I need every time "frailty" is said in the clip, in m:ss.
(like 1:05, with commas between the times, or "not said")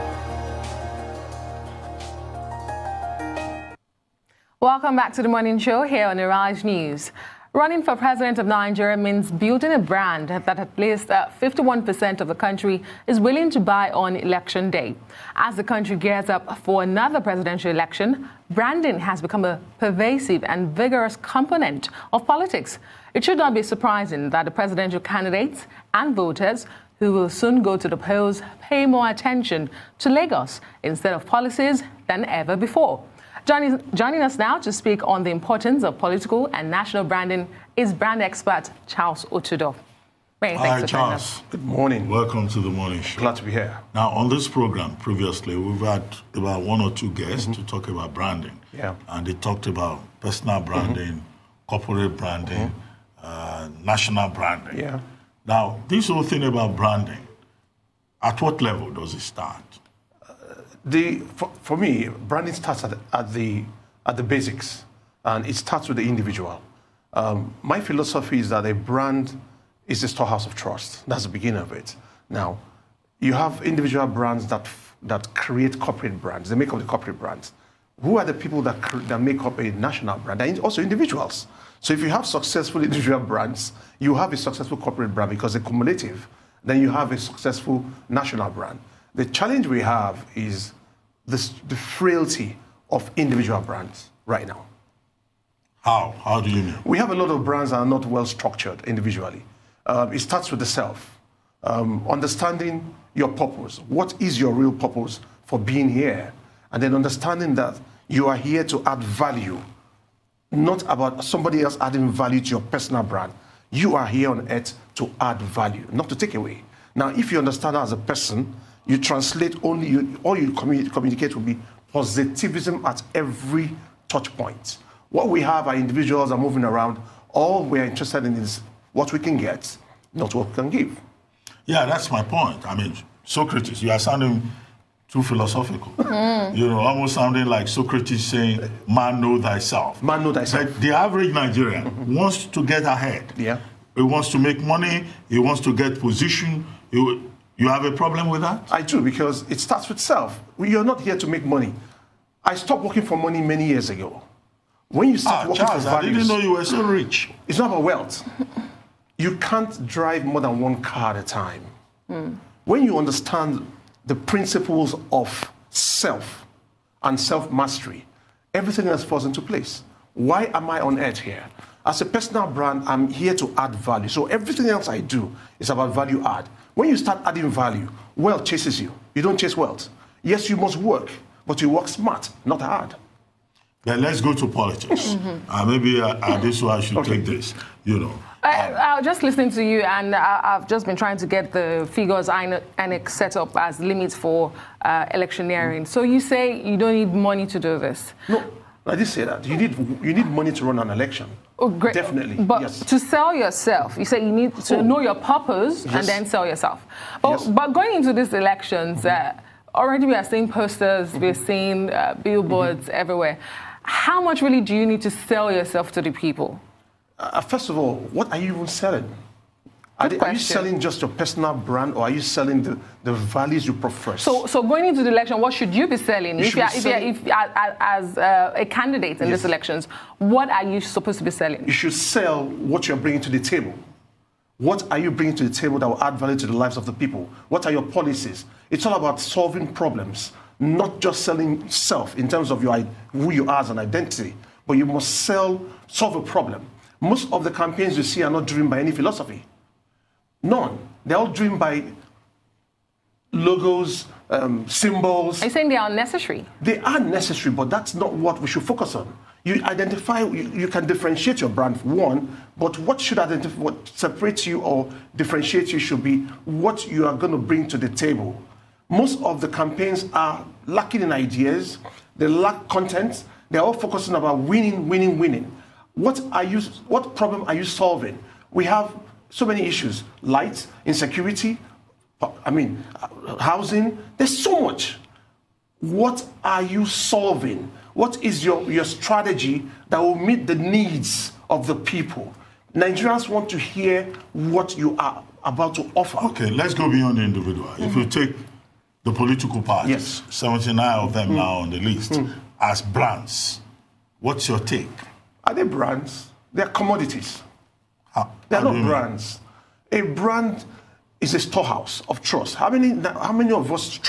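1:31.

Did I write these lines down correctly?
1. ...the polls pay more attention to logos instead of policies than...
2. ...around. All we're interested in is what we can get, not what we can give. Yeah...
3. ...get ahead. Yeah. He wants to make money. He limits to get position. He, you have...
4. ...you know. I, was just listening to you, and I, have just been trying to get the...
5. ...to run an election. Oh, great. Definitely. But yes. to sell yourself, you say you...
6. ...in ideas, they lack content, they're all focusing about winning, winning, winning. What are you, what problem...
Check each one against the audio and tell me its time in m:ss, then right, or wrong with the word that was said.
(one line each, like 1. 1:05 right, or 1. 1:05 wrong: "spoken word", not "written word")
1. 0:27 right
2. 2:06 right
3. 2:22 wrong: "wants", not "limits"
4. 3:07 right
5. 3:20 right
6. 4:31 right.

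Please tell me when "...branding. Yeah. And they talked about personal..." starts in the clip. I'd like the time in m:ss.
0:48.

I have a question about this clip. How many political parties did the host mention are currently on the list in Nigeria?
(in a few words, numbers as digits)
79.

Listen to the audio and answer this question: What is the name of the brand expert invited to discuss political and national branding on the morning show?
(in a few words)
Charles O'Tudor.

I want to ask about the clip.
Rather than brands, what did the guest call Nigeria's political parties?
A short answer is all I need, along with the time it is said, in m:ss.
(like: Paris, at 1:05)
Commodities, at 5:06.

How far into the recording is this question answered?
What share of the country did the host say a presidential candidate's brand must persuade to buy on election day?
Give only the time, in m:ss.
0:11.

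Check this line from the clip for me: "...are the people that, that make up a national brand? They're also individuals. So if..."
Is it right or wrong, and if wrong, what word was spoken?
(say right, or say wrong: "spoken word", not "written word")
right.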